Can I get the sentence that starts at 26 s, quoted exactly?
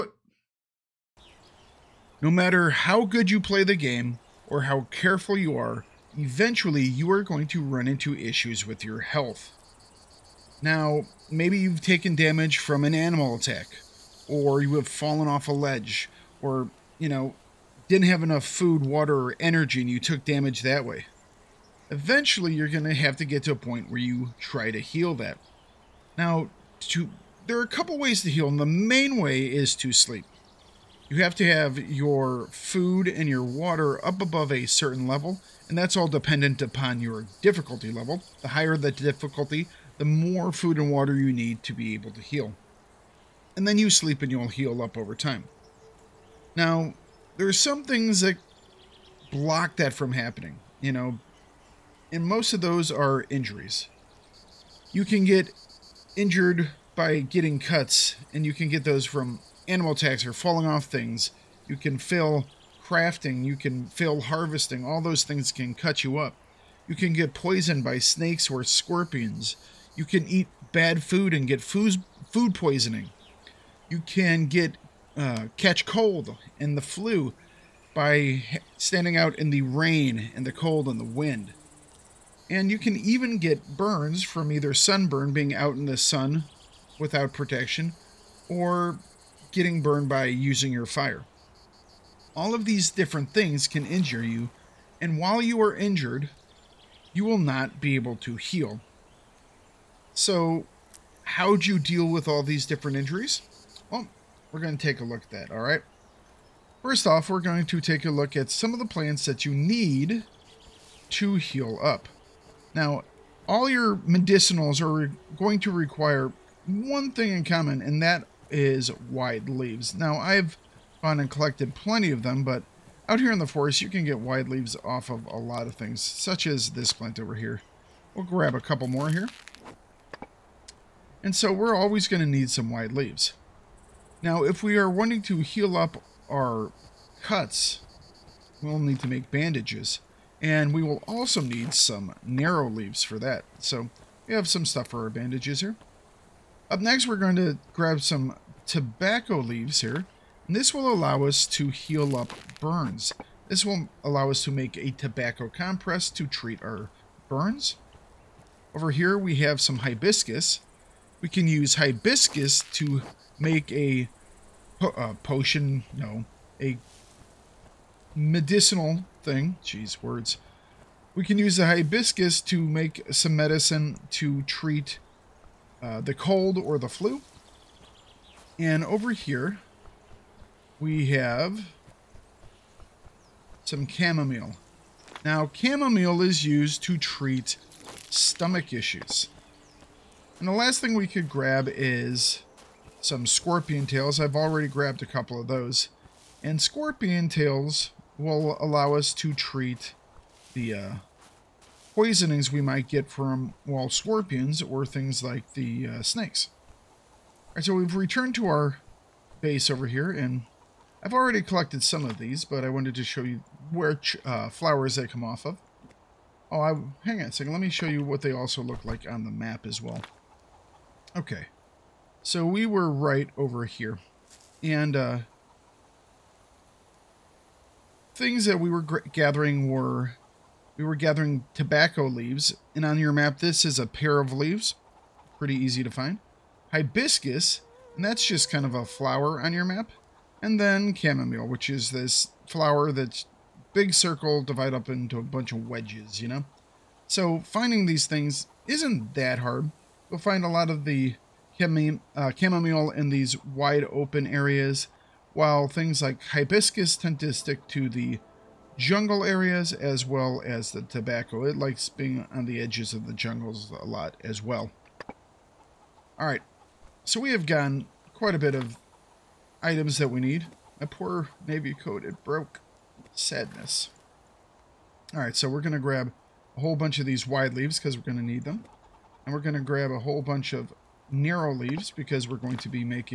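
Now, to there are a couple ways to heal, and the main way is to sleep.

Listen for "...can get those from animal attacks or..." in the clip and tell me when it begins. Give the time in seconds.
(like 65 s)
58 s.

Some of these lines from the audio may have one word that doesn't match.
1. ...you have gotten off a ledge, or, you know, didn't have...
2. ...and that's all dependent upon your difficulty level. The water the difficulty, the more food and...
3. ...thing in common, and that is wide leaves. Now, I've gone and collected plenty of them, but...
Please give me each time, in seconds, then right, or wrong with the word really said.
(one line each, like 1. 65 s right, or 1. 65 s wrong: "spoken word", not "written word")
1. 14 s wrong: "fallen", not "gotten"
2. 35 s wrong: "higher", not "water"
3. 117 s right.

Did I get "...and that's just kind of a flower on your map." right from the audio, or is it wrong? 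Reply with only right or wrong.
right.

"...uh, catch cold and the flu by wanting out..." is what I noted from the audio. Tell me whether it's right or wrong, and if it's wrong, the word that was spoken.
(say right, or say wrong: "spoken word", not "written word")
wrong: "standing", not "wanting".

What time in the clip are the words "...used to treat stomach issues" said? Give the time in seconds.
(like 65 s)
186 s.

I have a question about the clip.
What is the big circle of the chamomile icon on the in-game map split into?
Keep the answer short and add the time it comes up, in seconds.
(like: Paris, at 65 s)
Wedges, at 245 s.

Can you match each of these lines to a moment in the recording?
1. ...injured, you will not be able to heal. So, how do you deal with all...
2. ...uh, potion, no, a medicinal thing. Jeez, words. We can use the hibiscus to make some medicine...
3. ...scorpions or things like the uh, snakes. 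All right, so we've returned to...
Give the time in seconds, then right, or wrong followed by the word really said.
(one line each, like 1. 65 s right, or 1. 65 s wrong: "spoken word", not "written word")
1. 95 s right
2. 165 s right
3. 203 s right.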